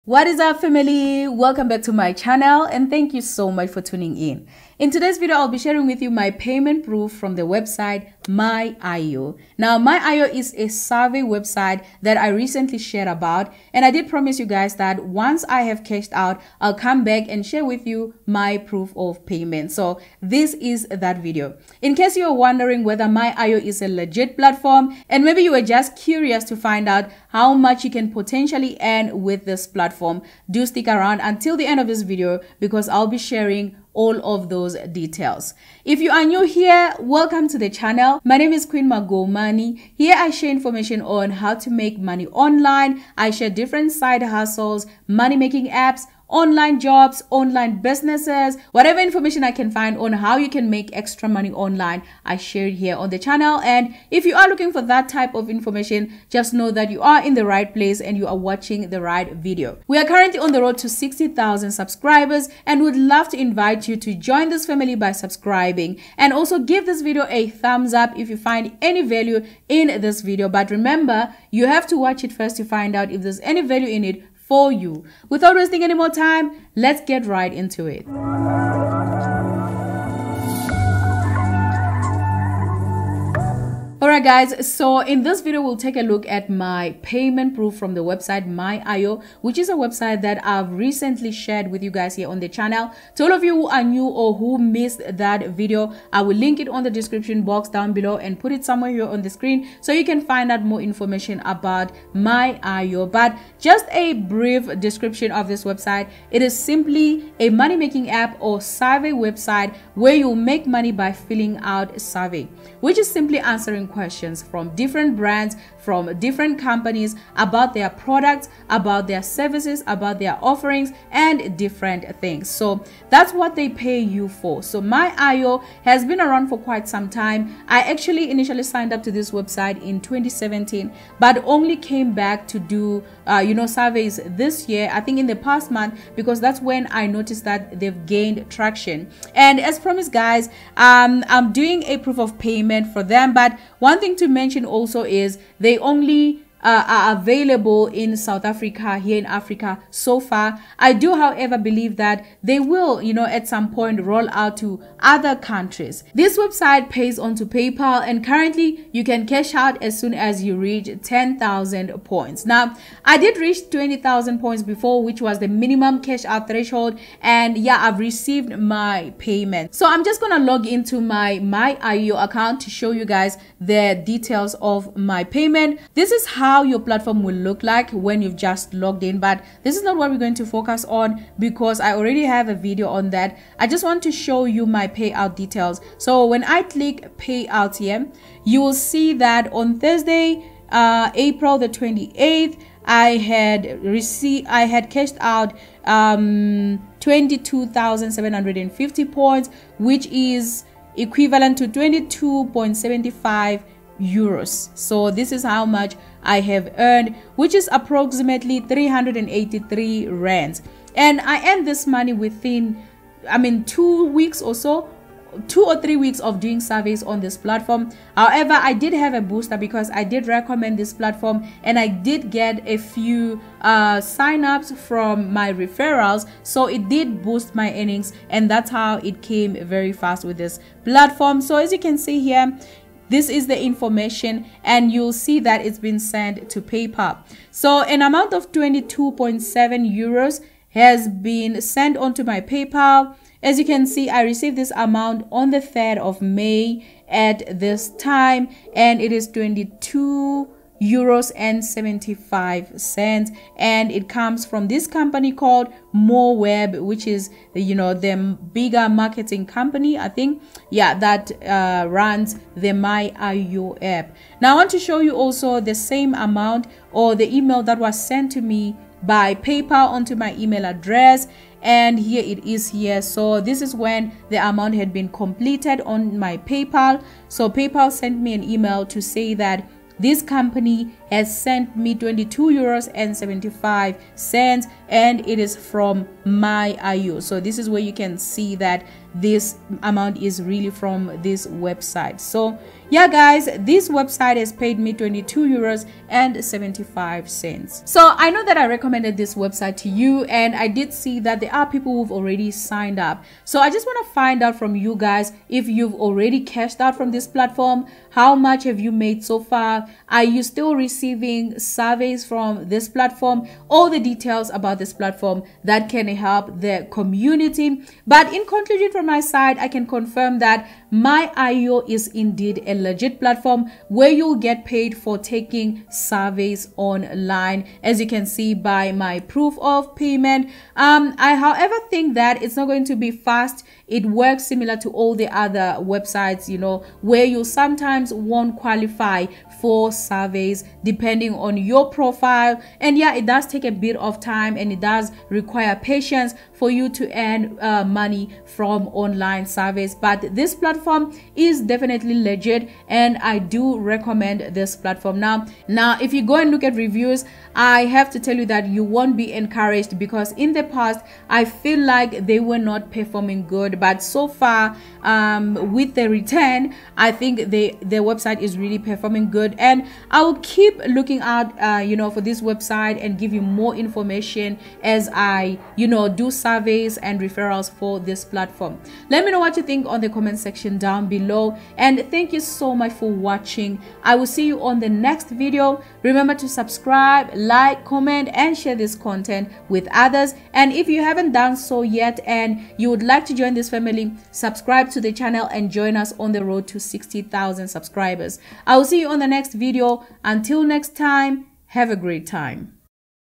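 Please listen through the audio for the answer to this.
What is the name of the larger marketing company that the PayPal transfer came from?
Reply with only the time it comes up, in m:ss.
4:15.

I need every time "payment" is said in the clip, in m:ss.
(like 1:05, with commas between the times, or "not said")
0:06, 0:19, 1:27, 2:22, 2:49, 2:55, 5:29.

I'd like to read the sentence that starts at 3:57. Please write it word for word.
So an amount of 22.7 euros has been sent onto my PayPal.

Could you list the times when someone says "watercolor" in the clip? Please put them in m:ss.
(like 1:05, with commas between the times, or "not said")
not said.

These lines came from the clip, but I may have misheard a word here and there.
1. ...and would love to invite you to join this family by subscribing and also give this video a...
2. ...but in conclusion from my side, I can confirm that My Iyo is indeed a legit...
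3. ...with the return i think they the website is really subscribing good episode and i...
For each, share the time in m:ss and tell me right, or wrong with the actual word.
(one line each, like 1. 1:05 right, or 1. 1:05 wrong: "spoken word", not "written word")
1. 1:02 right
2. 5:18 right
3. 6:05 wrong: "performing", not "subscribing".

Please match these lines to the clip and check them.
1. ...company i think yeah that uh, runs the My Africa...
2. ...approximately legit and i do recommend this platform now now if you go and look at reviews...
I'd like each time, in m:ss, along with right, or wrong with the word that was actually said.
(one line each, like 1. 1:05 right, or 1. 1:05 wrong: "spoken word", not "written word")
1. 4:19 wrong: "Iyo", not "Africa"
2. 5:51 wrong: "definitely", not "approximately".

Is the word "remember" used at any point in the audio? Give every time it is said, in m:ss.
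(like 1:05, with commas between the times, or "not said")
1:10, 6:26.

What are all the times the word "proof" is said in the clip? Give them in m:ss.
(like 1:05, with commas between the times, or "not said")
0:06, 0:18, 1:27, 2:22, 5:29.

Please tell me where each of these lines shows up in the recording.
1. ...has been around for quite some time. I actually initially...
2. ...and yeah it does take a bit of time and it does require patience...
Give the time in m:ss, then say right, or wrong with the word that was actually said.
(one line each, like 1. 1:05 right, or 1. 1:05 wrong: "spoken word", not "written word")
1. 2:05 right
2. 5:42 right.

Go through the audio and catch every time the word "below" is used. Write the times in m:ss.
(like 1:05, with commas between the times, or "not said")
1:37, 6:21.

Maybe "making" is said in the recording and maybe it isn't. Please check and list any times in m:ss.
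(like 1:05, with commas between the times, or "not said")
0:45, 1:47.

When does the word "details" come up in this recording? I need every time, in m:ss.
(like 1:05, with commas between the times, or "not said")
0:34, 2:54, 3:05, 5:13.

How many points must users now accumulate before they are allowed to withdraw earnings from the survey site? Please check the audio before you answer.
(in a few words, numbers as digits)
10,000 points.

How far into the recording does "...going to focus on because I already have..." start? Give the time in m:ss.
3:00.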